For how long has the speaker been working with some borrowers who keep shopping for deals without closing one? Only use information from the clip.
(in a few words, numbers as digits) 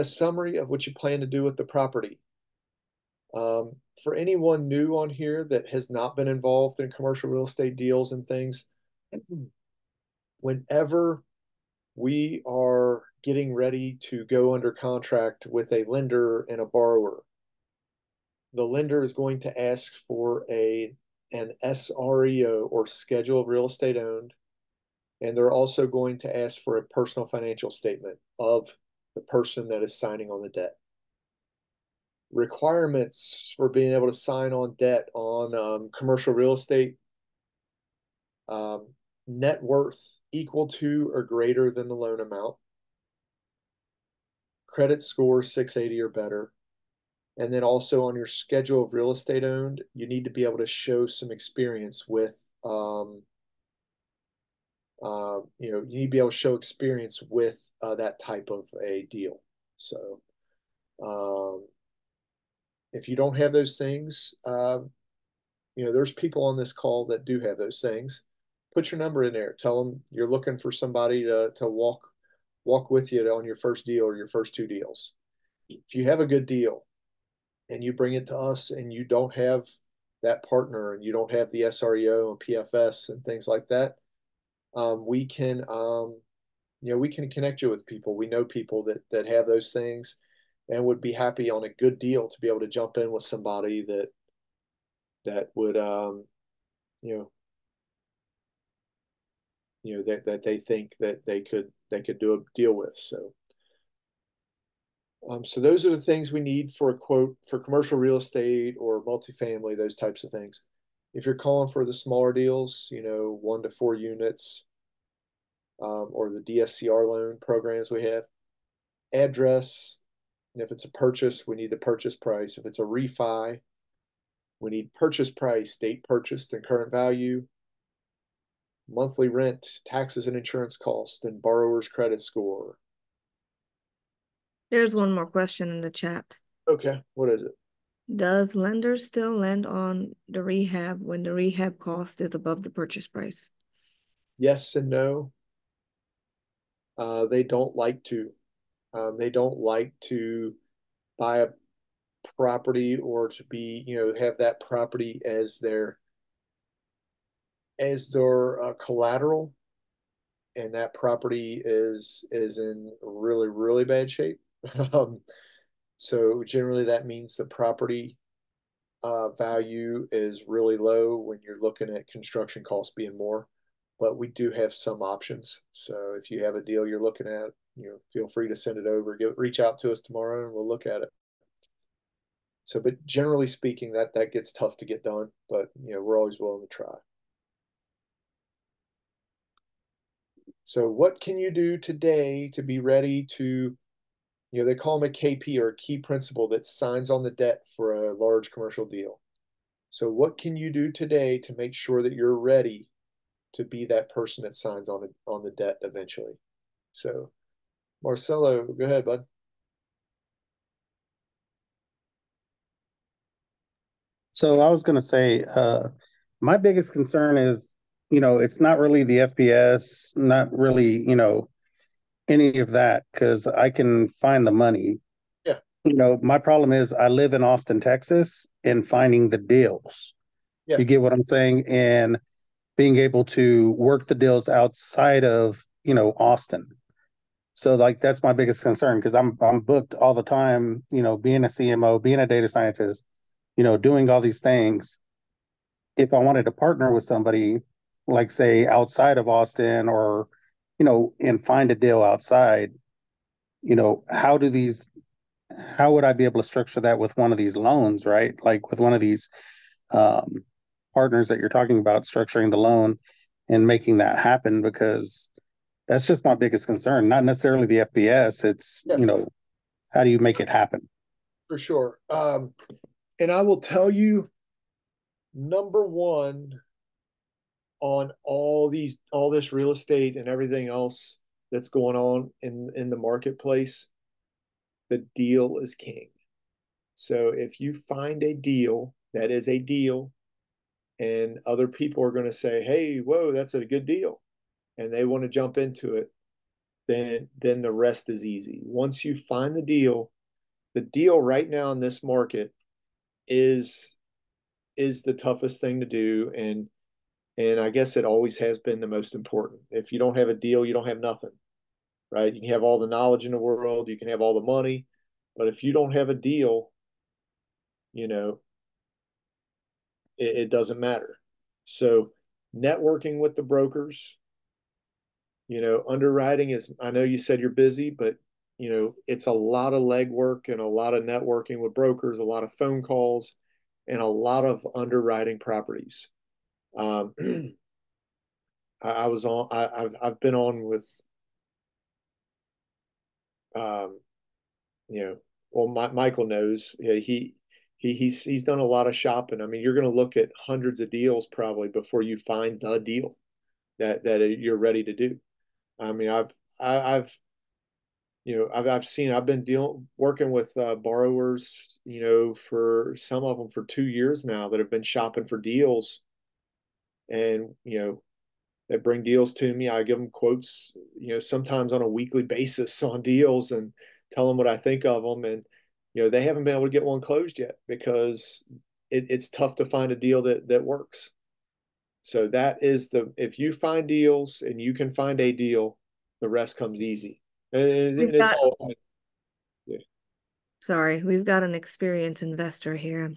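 2 years.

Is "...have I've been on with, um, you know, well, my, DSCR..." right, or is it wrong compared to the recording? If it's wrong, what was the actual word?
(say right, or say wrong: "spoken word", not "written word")
wrong: "Michael", not "DSCR".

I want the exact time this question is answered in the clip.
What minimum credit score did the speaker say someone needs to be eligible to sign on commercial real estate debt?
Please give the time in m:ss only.
0:44.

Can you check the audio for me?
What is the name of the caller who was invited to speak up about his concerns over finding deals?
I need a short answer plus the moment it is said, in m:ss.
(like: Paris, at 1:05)
Marcelo, at 3:28.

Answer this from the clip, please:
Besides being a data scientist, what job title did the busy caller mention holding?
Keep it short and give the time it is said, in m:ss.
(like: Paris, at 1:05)
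CMO, at 4:01.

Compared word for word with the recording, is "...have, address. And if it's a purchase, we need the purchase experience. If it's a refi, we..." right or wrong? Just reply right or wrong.
wrong.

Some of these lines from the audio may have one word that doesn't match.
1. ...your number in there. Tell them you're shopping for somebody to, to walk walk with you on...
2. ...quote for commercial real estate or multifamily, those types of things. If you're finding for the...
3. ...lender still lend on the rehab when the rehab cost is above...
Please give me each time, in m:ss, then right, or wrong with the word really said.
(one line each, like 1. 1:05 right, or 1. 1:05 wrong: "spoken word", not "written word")
1. 1:08 wrong: "looking", not "shopping"
2. 1:46 wrong: "calling", not "finding"
3. 2:18 right.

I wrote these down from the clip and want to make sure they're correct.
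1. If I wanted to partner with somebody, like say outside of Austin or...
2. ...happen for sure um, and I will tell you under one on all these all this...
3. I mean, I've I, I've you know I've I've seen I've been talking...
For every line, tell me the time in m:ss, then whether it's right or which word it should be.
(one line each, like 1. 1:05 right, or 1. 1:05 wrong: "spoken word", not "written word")
1. 4:05 right
2. 4:30 wrong: "number", not "under"
3. 5:55 wrong: "dealing", not "talking".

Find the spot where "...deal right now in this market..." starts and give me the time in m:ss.
5:00.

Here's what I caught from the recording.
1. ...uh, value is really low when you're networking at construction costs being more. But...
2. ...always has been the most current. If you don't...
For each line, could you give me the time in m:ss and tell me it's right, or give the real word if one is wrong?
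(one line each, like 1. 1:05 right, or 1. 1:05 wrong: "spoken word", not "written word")
1. 2:49 wrong: "looking", not "networking"
2. 5:08 wrong: "important", not "current".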